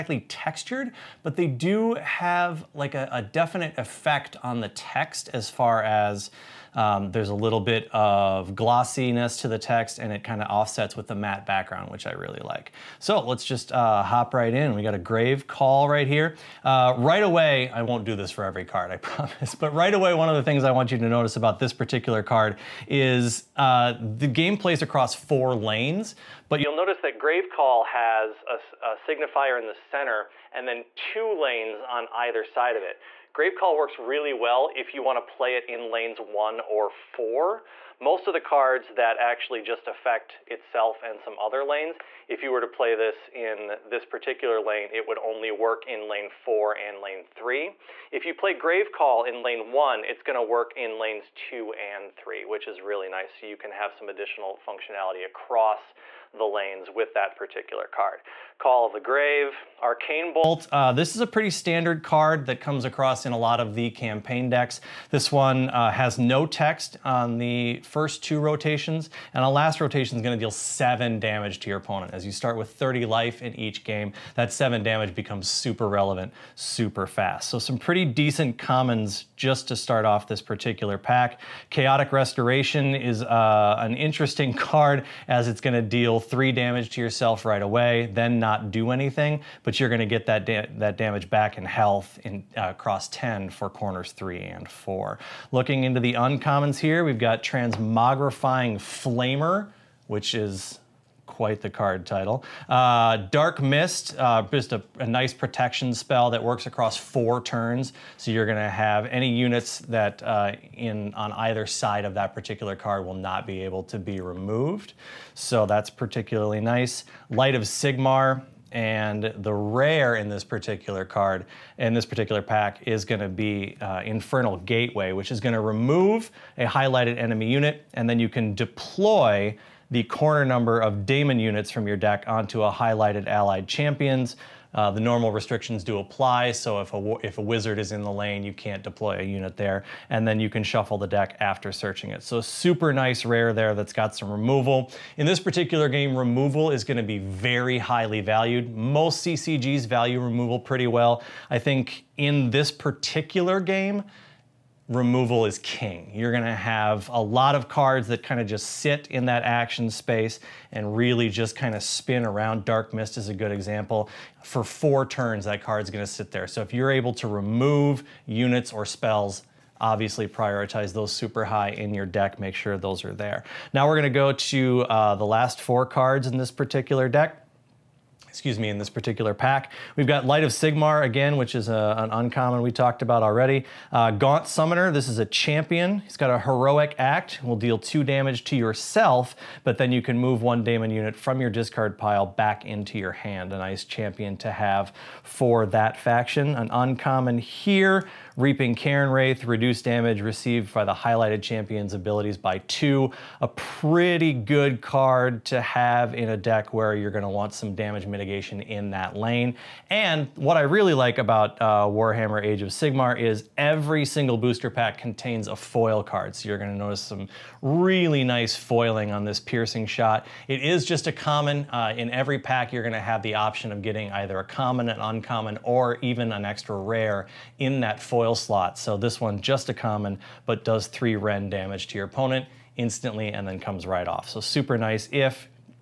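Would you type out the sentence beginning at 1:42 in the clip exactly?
Uh, Dark Mist, uh, just a, a, nice protection spell that works across four turns.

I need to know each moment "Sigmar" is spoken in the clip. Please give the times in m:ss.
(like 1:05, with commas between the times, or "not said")
1:57, 3:00, 3:32.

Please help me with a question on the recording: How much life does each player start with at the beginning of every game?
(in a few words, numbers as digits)
30.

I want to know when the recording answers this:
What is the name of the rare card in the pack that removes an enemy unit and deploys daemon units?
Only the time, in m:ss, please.
2:04.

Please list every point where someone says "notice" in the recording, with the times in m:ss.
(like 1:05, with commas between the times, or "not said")
0:21, 0:26, 3:36.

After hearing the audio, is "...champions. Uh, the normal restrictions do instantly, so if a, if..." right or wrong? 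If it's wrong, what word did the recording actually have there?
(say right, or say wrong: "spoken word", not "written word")
wrong: "apply", not "instantly".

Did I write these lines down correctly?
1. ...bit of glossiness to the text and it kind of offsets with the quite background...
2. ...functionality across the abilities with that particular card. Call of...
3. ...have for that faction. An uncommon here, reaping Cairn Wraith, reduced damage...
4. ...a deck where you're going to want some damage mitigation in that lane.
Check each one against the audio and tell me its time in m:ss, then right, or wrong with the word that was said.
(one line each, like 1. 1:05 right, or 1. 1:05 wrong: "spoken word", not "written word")
1. 0:07 wrong: "matte", not "quite"
2. 0:54 wrong: "lanes", not "abilities"
3. 3:14 right
4. 3:26 right.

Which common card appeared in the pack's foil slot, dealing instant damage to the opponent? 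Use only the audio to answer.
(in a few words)
Piercing Shot.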